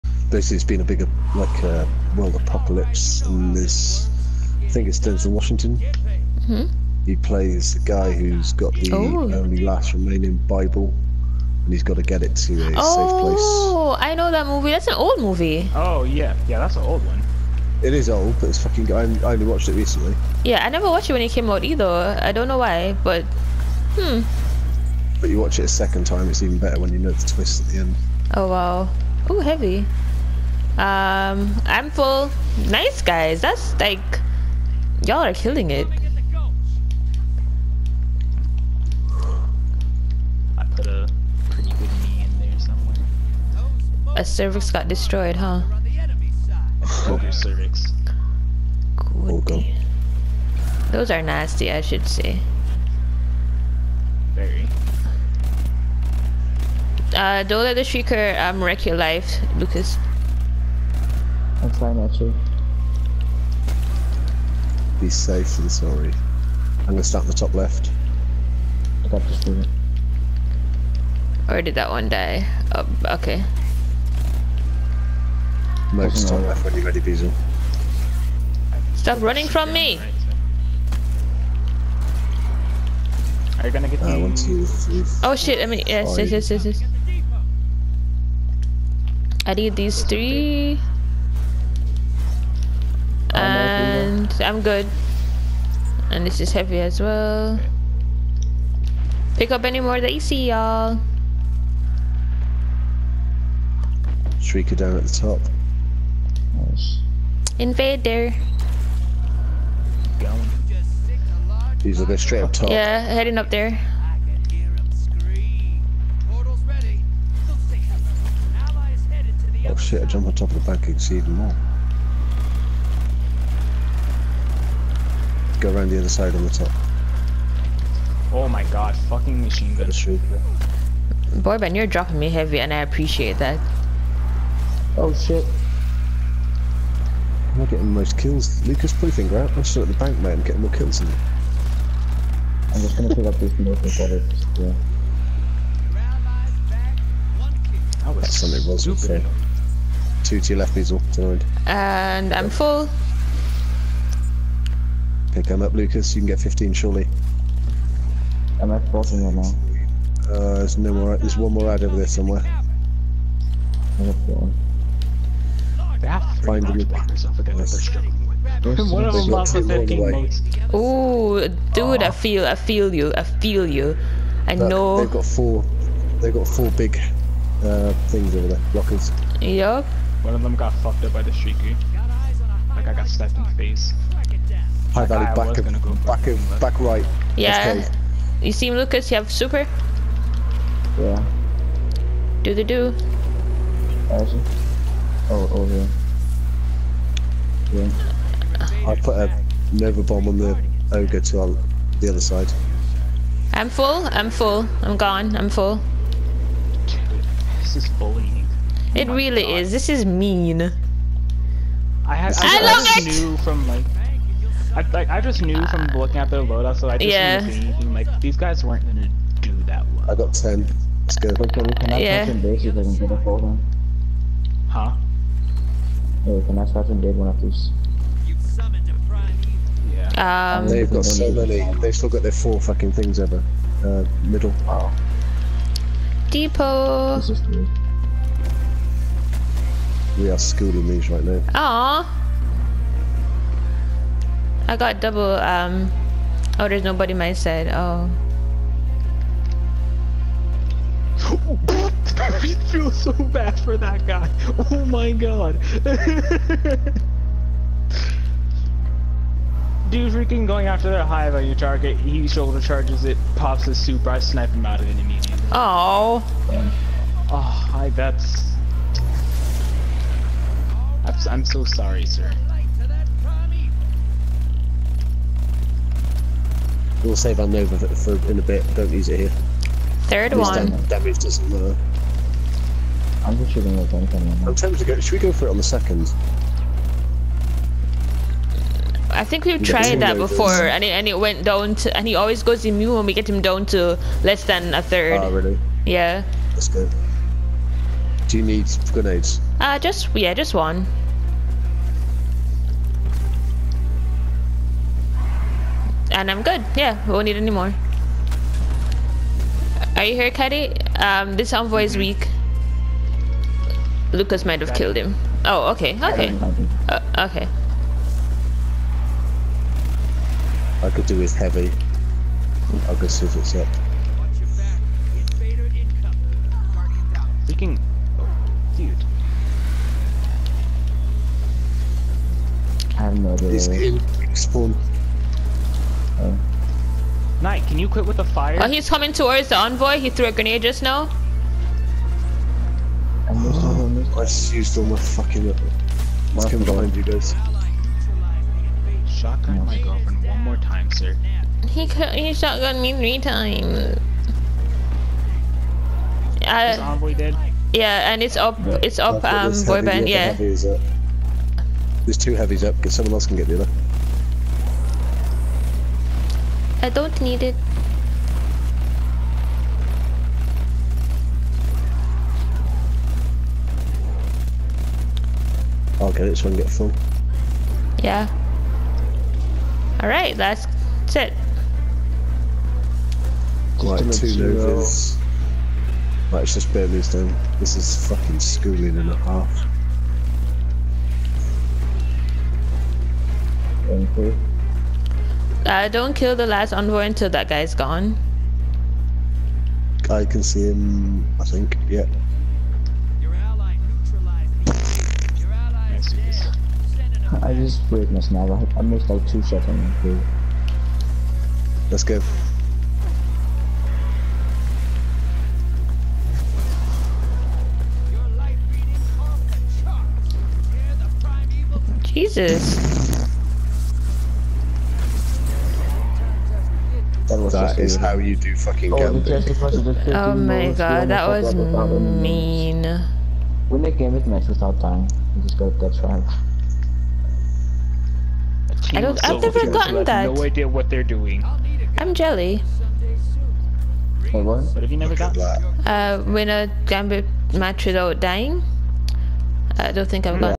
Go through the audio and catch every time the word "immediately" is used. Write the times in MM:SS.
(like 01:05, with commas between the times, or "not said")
04:25.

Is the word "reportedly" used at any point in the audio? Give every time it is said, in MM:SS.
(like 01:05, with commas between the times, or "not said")
not said.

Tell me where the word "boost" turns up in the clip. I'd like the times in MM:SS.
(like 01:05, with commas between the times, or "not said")
not said.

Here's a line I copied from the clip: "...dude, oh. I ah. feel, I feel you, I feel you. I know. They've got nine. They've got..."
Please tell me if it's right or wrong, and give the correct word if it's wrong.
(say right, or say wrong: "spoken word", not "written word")
wrong: "four", not "nine".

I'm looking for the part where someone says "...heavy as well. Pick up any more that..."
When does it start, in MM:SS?
01:36.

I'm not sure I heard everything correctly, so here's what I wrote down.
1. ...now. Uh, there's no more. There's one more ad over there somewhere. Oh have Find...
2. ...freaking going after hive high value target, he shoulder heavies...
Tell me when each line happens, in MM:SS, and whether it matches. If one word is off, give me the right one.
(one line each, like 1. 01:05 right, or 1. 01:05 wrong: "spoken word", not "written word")
1. 02:39 right
2. 04:20 wrong: "charges", not "heavies".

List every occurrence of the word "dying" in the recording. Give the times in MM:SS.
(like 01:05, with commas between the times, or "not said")
07:14, 07:28.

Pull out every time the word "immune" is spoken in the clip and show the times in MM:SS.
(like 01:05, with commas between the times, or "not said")
04:52.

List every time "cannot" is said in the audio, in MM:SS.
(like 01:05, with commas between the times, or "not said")
03:41, 03:46.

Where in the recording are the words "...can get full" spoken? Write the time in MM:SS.
06:16.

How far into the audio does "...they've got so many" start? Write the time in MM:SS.
03:50.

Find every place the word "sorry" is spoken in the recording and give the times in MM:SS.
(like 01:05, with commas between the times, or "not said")
01:05, 04:31.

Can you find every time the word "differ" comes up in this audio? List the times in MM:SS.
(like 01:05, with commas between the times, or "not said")
not said.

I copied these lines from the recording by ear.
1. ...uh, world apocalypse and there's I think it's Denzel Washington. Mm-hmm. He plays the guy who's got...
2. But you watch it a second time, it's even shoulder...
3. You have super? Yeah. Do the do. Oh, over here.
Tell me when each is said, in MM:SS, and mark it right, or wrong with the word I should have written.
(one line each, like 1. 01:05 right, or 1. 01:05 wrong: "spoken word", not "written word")
1. 00:01 right
2. 00:25 wrong: "better", not "shoulder"
3. 03:09 right.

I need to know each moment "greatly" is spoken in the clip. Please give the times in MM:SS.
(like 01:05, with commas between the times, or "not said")
not said.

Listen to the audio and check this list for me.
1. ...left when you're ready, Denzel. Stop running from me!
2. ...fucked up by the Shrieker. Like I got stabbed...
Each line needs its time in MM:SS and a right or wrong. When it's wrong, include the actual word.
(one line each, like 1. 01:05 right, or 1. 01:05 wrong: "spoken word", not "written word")
1. 01:16 wrong: "Beezle", not "Denzel"
2. 03:00 right.